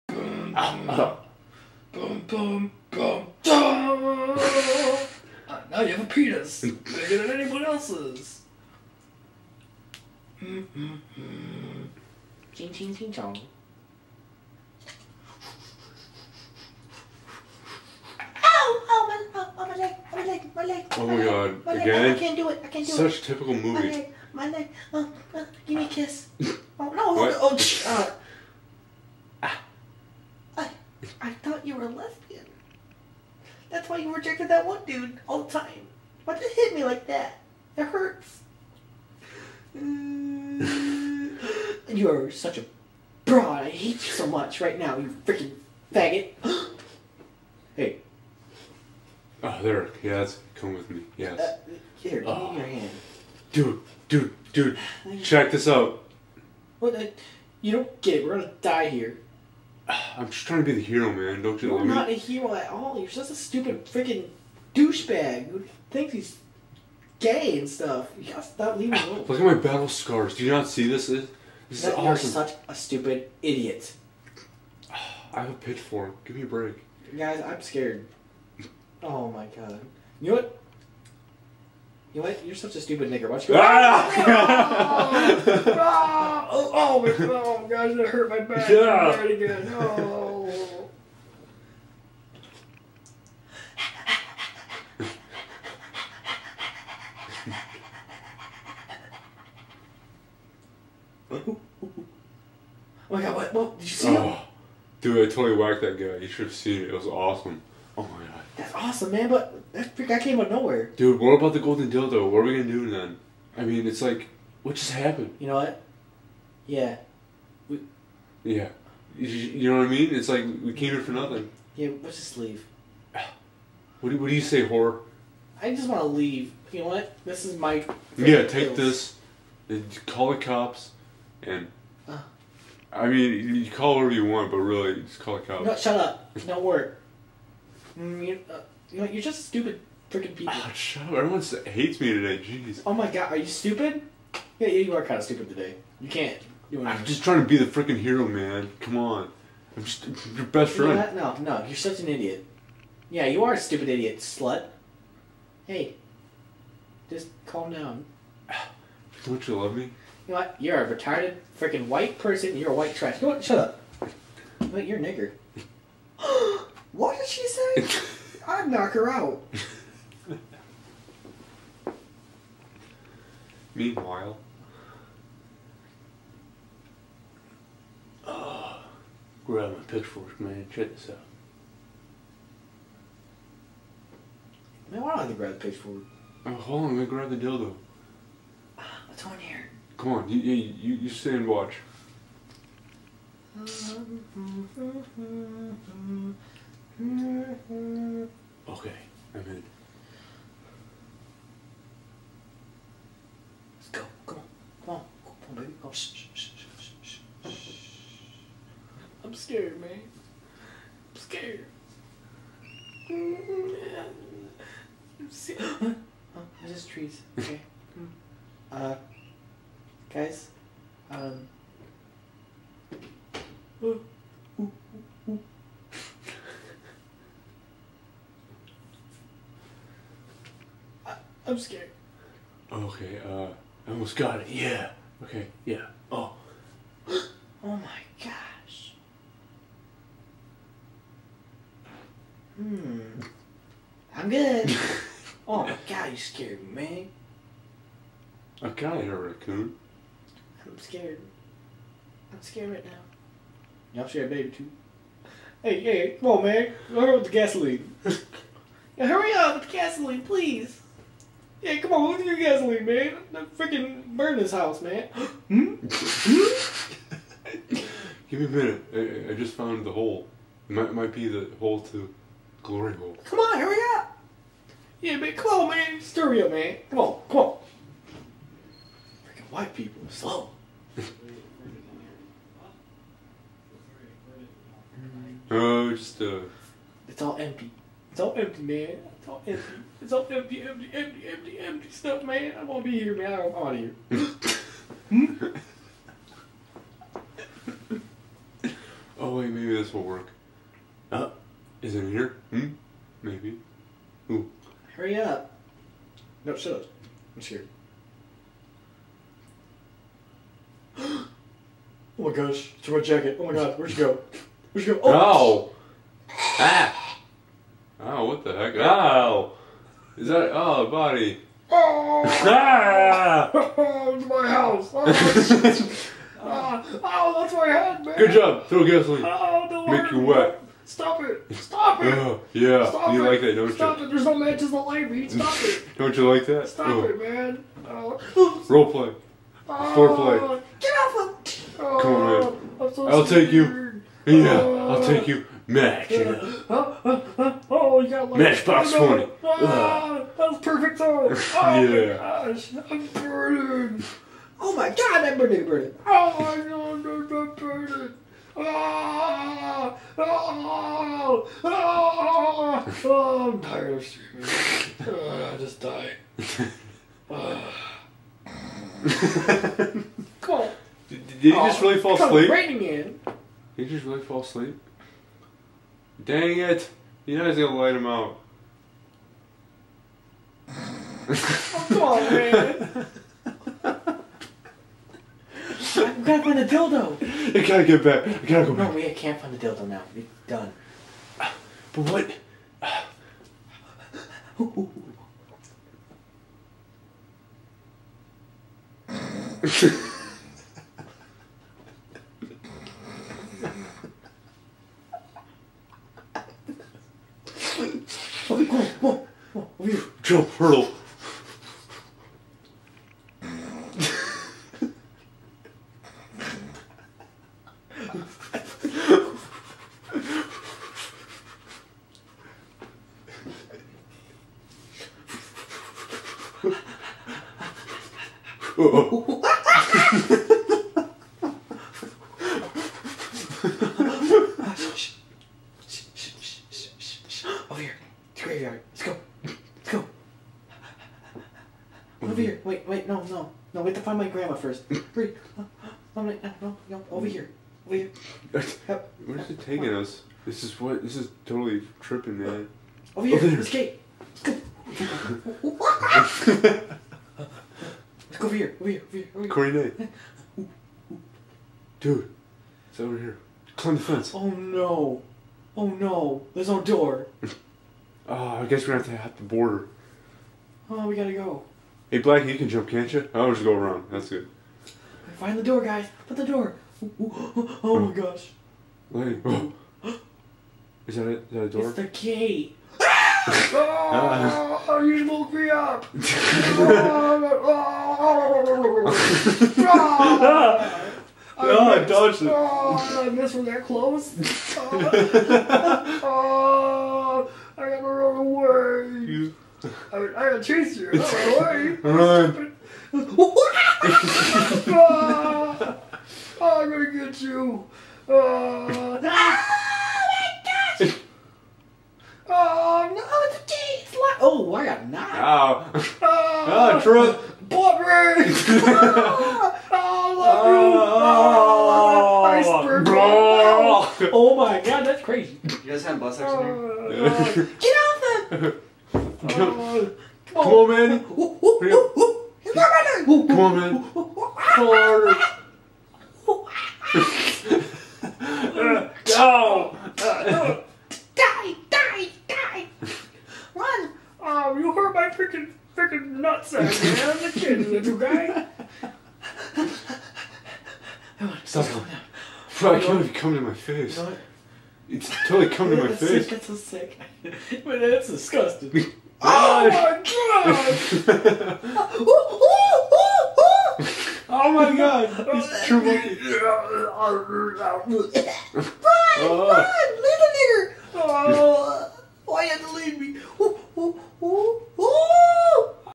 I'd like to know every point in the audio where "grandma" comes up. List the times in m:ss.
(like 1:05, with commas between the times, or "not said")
7:24.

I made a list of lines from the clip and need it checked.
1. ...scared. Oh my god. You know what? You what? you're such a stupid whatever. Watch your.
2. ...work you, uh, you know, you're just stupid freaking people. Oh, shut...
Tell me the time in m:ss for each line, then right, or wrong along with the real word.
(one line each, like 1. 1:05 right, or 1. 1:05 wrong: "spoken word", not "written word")
1. 1:17 wrong: "nigger", not "whatever"
2. 2:16 right.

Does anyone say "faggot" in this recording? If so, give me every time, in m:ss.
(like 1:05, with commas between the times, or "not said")
0:45.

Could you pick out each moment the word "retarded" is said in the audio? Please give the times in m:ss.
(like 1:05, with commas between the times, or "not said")
2:40.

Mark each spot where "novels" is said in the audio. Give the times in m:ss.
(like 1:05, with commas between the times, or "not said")
not said.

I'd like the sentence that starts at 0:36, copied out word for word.
Why'd you hit me like that?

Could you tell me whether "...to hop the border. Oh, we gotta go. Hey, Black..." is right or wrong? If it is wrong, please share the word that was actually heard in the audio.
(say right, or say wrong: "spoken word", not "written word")
right.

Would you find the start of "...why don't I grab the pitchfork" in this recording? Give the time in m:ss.
3:05.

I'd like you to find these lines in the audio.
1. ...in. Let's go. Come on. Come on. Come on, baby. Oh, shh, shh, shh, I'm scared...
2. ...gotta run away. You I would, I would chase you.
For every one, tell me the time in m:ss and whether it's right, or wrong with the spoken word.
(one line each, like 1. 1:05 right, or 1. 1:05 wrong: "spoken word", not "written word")
1. 3:19 right
2. 8:17 right.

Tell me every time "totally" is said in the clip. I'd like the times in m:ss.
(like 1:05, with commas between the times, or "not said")
1:45, 7:31, 9:15.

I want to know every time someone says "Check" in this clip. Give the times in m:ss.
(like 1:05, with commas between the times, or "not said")
0:55, 3:00.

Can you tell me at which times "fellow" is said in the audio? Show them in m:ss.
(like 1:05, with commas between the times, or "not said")
not said.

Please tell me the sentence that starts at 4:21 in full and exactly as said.
Yeah, come on, look at your gasoline, man.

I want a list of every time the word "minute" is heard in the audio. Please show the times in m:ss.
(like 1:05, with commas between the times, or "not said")
4:28.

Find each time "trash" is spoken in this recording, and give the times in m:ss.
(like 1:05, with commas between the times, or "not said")
2:42.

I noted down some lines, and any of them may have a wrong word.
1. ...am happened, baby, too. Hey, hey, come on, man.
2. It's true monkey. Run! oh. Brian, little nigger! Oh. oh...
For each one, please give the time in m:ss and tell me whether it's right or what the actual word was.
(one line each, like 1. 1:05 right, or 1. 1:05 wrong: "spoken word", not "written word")
1. 4:14 wrong: "scared", not "happened"
2. 9:25 right.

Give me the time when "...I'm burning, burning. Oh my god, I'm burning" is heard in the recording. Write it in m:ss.
5:55.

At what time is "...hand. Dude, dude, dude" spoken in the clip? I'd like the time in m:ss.
0:52.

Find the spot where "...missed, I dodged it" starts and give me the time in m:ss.
8:11.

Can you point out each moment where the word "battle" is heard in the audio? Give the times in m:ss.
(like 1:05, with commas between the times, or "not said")
1:09.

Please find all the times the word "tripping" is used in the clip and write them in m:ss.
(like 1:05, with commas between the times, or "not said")
7:31.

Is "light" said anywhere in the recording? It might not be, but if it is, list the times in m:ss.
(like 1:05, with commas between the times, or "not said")
5:34, 6:17.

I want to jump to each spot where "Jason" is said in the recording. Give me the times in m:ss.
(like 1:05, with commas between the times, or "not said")
not said.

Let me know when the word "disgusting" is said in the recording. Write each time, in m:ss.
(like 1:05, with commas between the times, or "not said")
9:18.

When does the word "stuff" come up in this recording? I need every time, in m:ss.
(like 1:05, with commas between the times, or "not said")
1:07, 4:51.